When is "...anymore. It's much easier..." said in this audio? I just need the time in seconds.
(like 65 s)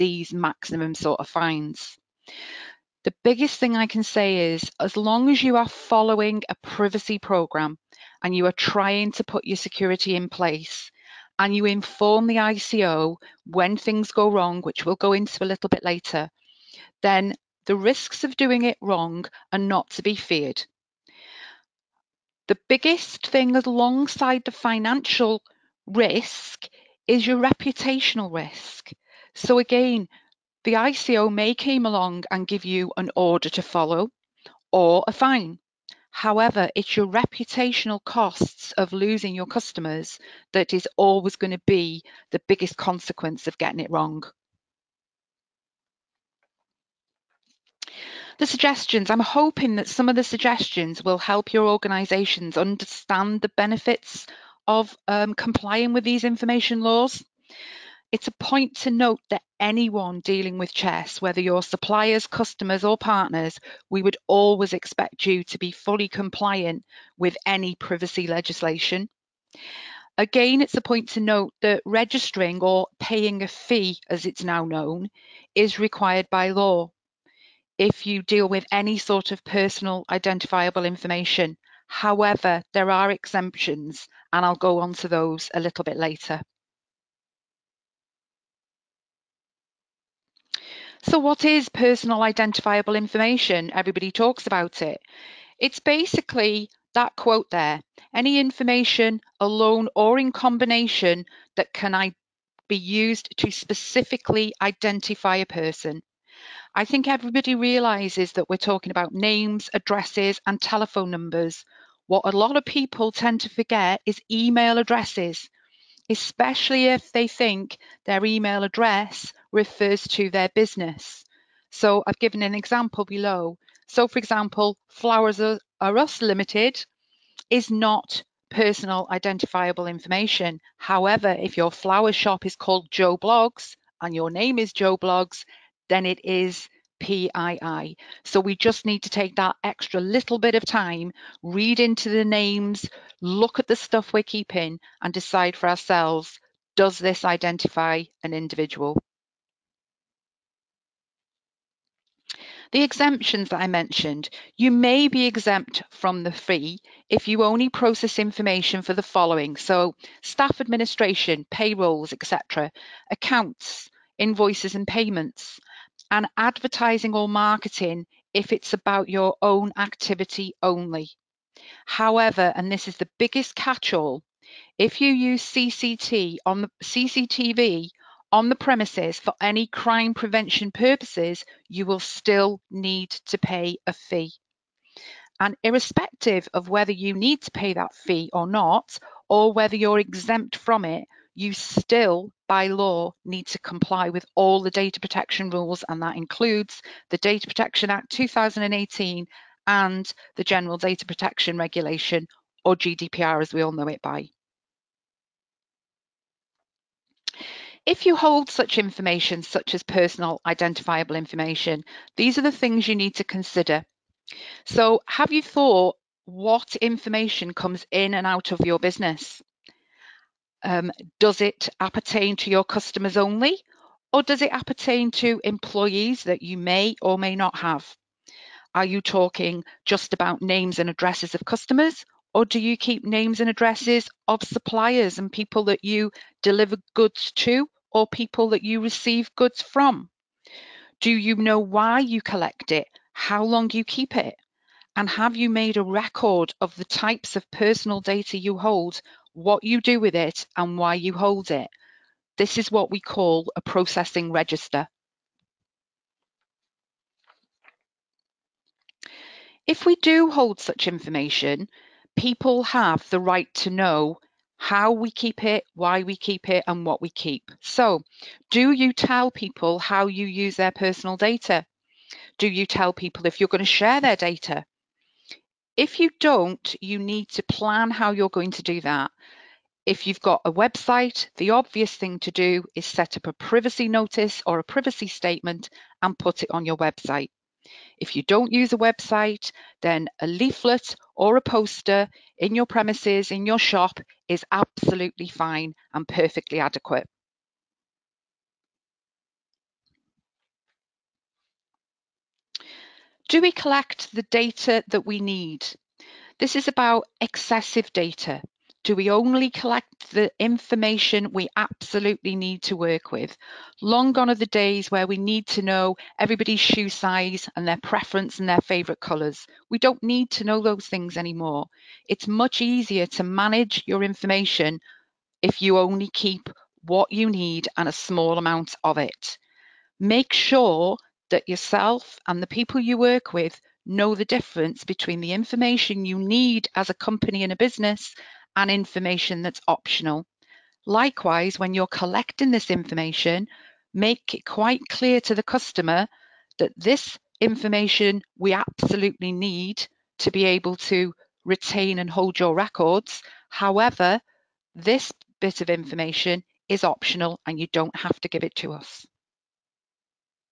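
321 s.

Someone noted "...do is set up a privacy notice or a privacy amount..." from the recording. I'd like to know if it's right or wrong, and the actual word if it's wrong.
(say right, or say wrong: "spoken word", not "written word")
wrong: "statement", not "amount".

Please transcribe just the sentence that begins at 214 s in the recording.
So have you thought what information comes in and out of your business?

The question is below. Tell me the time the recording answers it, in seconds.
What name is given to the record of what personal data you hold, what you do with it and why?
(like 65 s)
253 s.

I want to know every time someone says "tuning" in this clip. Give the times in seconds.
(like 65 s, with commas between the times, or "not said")
not said.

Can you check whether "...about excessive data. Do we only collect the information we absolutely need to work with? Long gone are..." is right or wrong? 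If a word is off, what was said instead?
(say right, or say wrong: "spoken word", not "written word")
right.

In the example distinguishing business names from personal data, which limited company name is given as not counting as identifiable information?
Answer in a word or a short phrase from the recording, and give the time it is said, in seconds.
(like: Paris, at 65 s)
Flowers Are Us Limited, at 124 s.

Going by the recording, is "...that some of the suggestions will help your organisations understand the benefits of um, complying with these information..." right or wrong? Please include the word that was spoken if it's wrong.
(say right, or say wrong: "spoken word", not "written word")
right.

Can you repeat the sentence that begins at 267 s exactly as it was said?
So, do you tell people how you use their personal data?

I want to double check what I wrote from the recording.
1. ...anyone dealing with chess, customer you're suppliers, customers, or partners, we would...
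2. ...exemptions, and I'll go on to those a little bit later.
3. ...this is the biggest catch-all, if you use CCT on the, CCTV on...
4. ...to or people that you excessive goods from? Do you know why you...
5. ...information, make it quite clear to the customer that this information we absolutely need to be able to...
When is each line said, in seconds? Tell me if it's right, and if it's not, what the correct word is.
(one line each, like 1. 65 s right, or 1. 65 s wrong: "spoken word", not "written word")
1. 59 s wrong: "whether", not "customer"
2. 83 s right
3. 172 s right
4. 237 s wrong: "receive", not "excessive"
5. 342 s right.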